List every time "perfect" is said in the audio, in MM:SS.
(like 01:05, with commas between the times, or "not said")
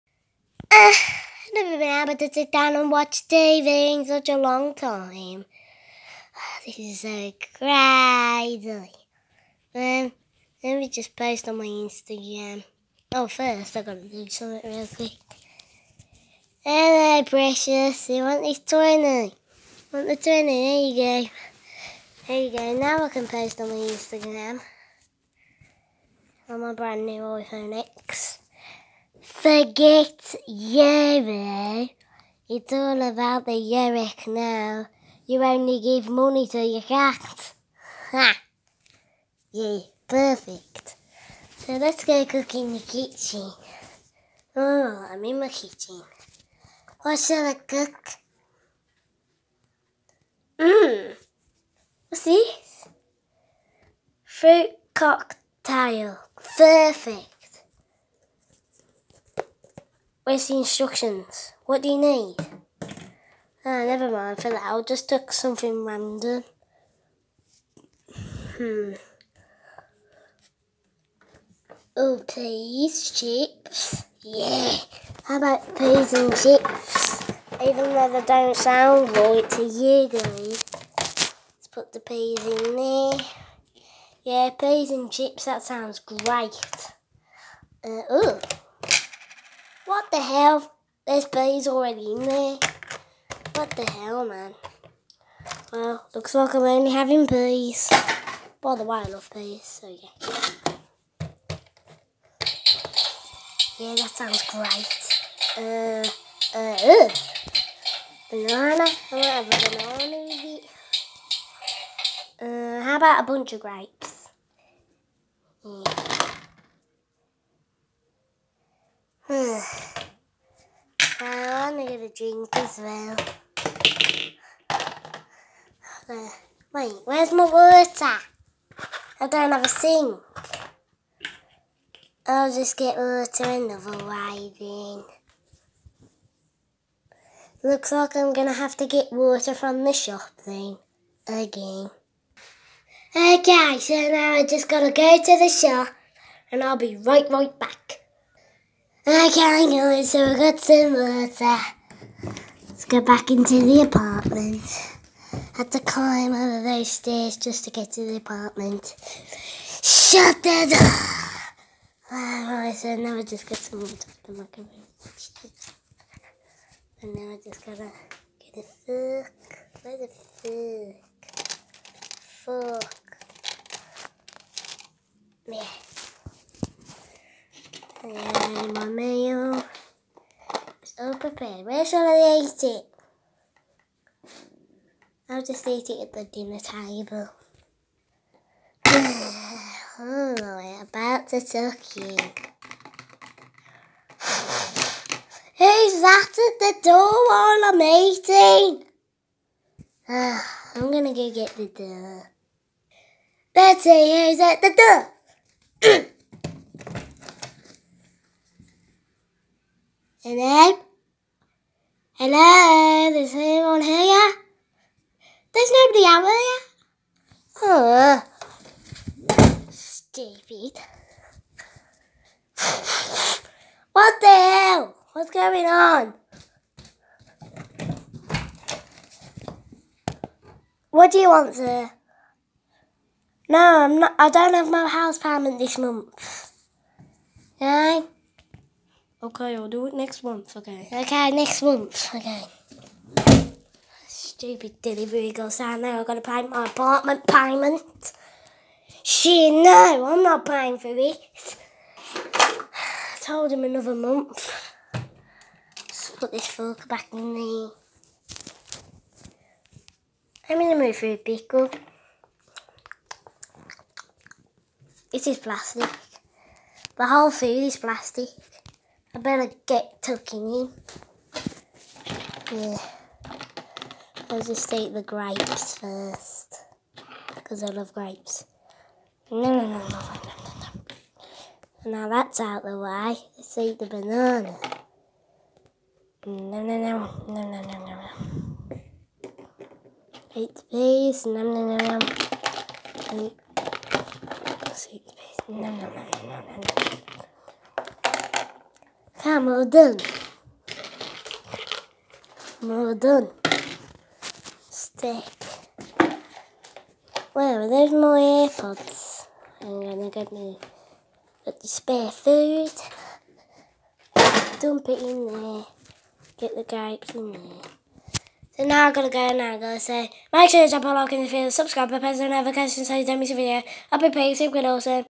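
00:40, 00:56.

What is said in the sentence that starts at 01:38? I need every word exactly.
By the way, I love peas, so yeah.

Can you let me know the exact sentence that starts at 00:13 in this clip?
Oh, first I gotta do something real quick.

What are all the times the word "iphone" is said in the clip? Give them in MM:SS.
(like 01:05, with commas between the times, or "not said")
00:27.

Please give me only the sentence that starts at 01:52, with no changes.
Uh, how about a bunch of grapes?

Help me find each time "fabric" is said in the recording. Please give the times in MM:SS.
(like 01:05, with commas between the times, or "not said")
not said.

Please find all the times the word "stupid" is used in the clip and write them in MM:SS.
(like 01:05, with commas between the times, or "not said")
03:39, 04:04.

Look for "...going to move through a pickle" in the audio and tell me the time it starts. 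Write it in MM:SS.
04:20.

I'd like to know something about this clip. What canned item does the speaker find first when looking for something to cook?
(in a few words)
Fruit cocktail.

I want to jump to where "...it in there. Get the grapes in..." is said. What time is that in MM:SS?
05:14.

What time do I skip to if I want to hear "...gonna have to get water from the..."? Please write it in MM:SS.
02:18.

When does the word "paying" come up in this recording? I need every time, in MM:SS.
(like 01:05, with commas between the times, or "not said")
04:10, 05:24.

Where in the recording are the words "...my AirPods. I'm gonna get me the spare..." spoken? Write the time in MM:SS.
05:07.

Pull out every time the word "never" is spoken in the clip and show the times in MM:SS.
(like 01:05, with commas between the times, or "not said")
00:01, 01:03.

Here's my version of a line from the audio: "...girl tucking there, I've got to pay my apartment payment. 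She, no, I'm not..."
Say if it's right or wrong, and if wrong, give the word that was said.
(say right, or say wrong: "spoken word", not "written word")
wrong: "saying", not "tucking".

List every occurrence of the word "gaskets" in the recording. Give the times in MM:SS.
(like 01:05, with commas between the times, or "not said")
not said.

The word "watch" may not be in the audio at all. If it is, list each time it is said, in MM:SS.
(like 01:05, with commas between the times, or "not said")
00:02.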